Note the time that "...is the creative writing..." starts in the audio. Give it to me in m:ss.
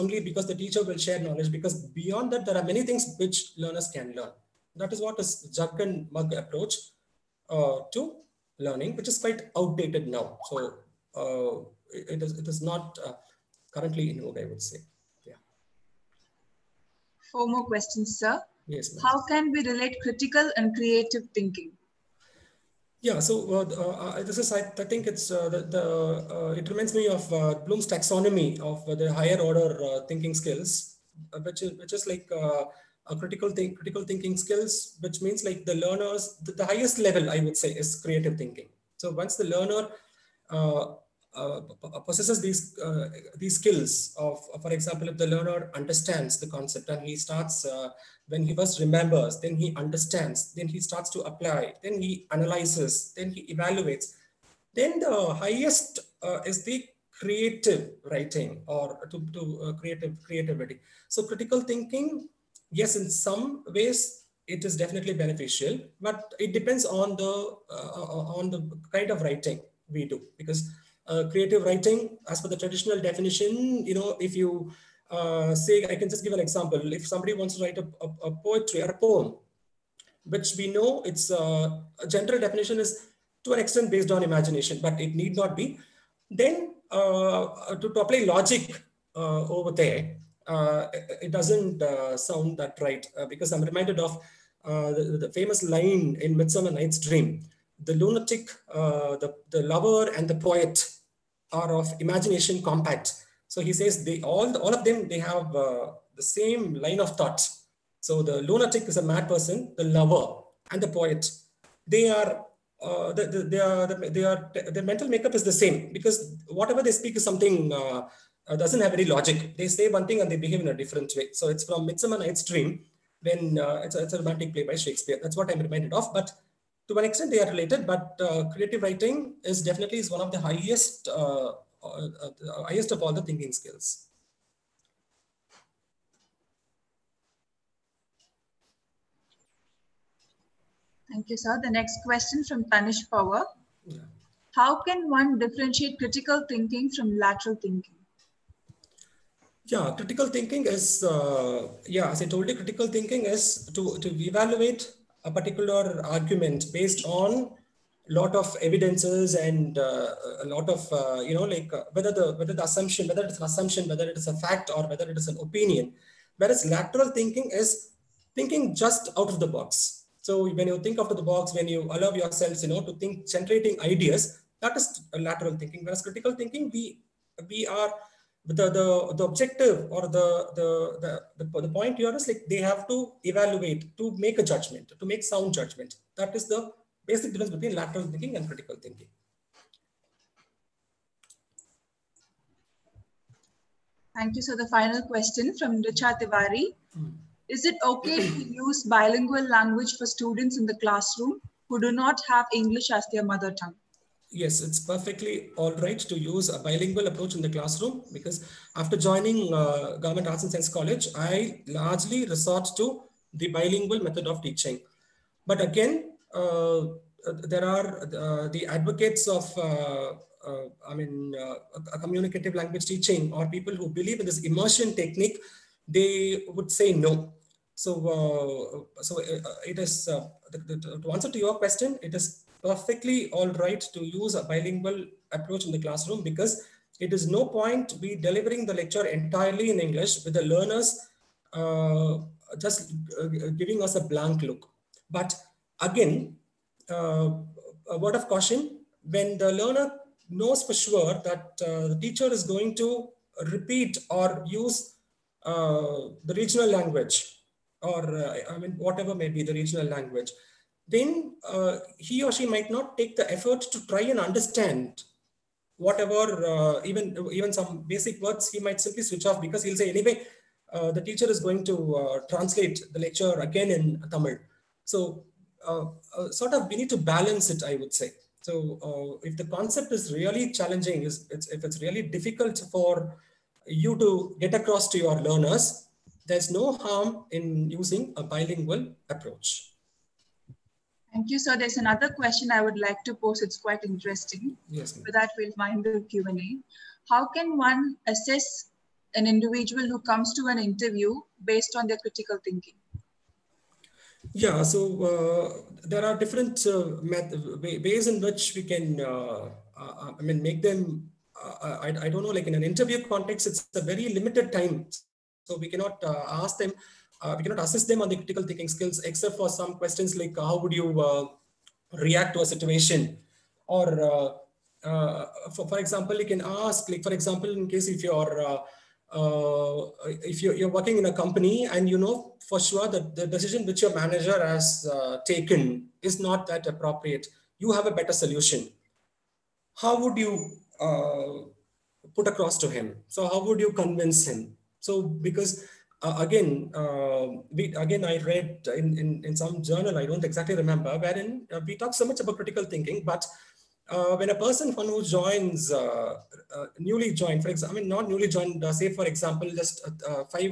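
0:56.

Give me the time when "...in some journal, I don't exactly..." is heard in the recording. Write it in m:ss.
5:49.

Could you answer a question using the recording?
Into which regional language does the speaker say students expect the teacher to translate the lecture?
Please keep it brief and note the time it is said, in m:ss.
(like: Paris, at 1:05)
Tamil, at 4:34.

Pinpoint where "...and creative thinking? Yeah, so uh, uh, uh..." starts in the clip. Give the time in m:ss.
0:20.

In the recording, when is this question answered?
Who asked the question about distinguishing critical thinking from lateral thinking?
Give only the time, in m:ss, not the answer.
2:22.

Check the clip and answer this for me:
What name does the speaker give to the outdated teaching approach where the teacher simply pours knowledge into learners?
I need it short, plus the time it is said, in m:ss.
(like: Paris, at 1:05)
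Jug and Mug approach, at 0:05.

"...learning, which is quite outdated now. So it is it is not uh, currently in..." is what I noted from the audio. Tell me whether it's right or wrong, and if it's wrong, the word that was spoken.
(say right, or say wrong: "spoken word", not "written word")
right.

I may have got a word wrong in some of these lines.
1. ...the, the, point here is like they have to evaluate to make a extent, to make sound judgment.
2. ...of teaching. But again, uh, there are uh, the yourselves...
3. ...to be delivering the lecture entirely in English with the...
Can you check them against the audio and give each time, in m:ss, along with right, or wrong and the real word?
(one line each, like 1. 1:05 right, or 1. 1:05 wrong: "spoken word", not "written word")
1. 3:01 wrong: "judgment", not "extent"
2. 3:34 wrong: "advocates", not "yourselves"
3. 3:57 right.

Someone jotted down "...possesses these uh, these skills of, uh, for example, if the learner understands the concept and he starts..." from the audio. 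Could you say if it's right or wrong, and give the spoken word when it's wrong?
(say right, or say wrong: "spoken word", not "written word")
right.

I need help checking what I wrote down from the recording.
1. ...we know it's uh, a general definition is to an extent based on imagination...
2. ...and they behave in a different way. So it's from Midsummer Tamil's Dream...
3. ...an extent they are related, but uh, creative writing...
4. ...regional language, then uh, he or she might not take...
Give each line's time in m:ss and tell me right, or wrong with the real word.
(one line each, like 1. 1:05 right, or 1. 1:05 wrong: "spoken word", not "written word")
1. 1:20 right
2. 2:00 wrong: "Night", not "Tamil"
3. 2:06 right
4. 4:19 right.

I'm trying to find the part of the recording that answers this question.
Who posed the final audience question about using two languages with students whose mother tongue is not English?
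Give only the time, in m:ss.
3:15.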